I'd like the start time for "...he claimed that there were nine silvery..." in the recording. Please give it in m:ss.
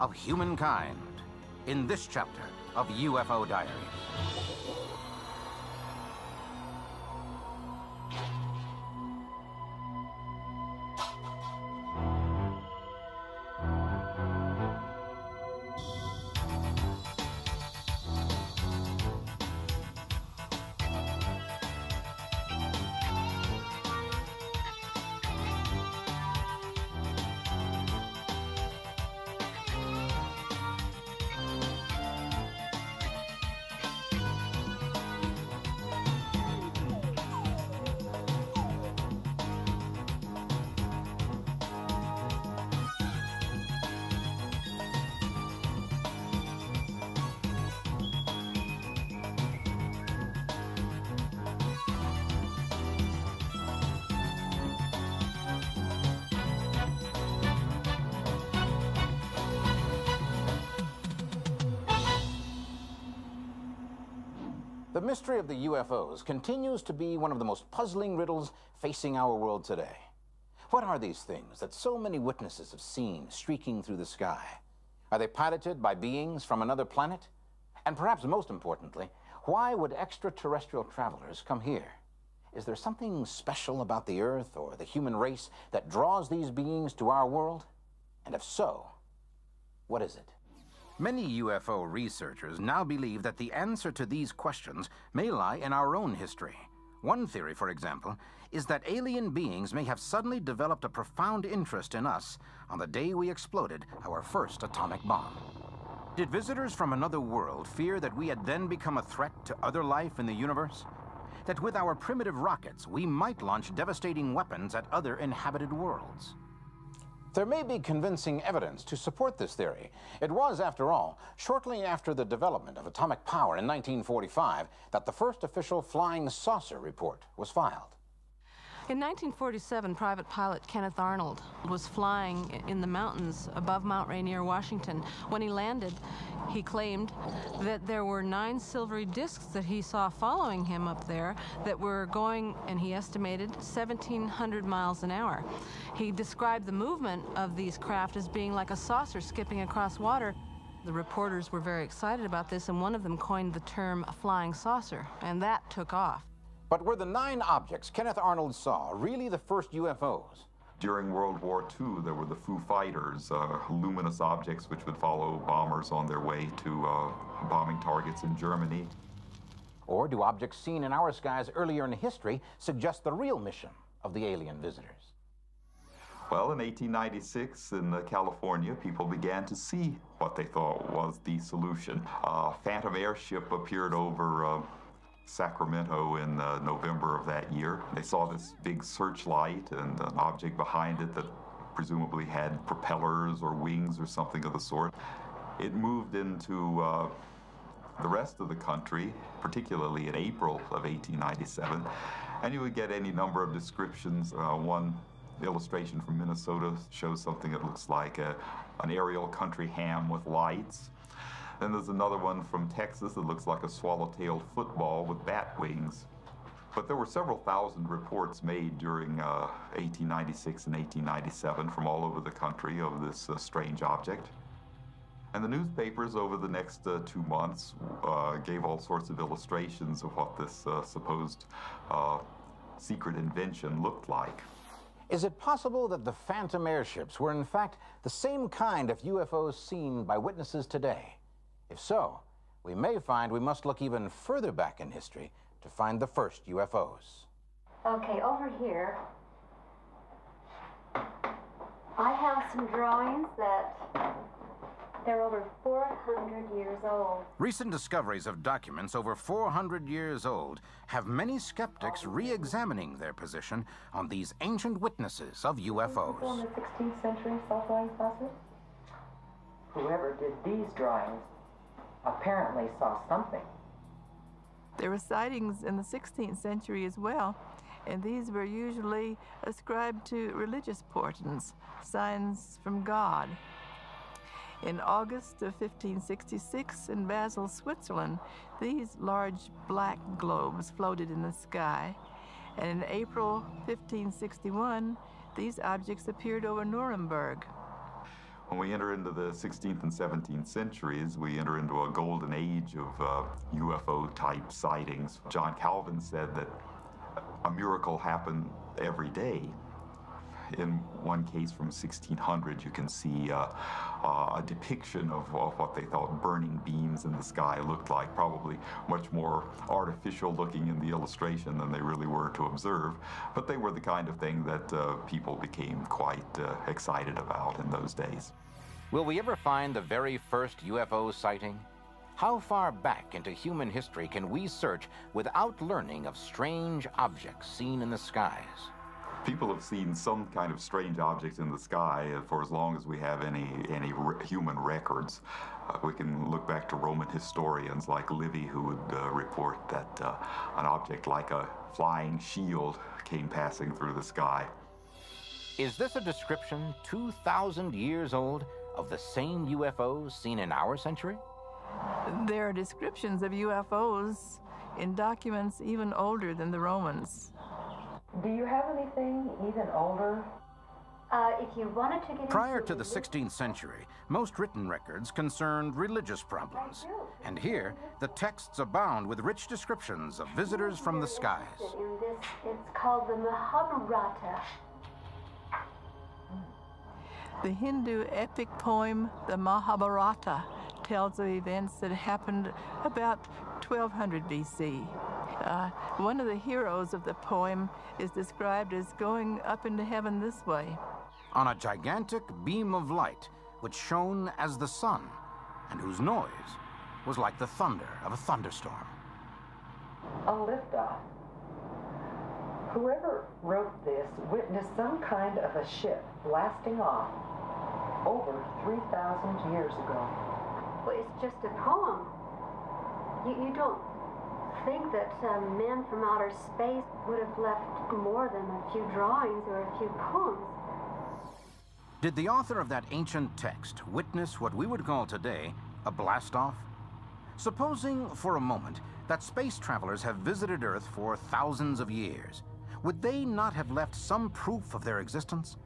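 2:16.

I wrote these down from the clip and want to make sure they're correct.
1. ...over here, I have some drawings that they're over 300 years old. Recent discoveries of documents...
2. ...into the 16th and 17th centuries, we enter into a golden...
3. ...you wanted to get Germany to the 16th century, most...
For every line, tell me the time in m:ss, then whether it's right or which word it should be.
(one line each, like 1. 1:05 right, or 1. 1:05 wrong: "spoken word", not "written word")
1. 4:08 wrong: "400", not "300"
2. 4:58 right
3. 6:11 wrong: "Prior", not "Germany".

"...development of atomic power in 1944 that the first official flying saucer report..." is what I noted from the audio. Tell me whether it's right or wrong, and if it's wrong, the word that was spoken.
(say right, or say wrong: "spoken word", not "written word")
wrong: "1945", not "1944".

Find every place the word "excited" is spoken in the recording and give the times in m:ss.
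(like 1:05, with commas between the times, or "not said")
2:31, 5:26.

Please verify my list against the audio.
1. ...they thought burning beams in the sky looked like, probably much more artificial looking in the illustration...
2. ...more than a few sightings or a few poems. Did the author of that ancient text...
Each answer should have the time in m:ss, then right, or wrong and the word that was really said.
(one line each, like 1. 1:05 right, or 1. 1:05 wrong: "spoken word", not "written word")
1. 5:15 right
2. 7:07 wrong: "drawings", not "sightings".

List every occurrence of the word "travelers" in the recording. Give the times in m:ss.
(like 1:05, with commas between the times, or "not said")
1:20, 7:19.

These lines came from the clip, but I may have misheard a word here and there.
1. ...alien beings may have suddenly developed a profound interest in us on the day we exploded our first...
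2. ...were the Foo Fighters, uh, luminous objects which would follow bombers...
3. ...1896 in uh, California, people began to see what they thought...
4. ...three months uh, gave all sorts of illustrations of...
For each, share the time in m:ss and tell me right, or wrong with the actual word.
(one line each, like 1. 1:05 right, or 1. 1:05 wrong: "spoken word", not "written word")
1. 1:38 right
2. 2:42 right
3. 2:56 right
4. 3:47 wrong: "two", not "three".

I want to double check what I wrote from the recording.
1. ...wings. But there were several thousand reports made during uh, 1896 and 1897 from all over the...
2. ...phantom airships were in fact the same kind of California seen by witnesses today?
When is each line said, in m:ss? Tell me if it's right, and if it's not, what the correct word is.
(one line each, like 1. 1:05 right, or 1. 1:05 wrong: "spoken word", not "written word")
1. 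3:35 right
2. 3:56 wrong: "UFOs", not "California".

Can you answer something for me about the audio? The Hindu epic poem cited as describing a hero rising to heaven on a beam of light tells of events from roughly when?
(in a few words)
1200 BC.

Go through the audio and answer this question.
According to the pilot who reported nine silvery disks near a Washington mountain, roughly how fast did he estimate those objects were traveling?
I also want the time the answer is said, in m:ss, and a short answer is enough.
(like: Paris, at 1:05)
1,700 miles an hour, at 2:23.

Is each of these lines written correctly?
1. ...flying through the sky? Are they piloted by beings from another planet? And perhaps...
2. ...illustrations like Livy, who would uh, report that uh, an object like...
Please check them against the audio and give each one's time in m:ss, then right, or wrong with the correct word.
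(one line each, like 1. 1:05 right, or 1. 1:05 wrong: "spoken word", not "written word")
1. 1:13 wrong: "streaking", not "flying"
2. 5:47 wrong: "historians", not "illustrations".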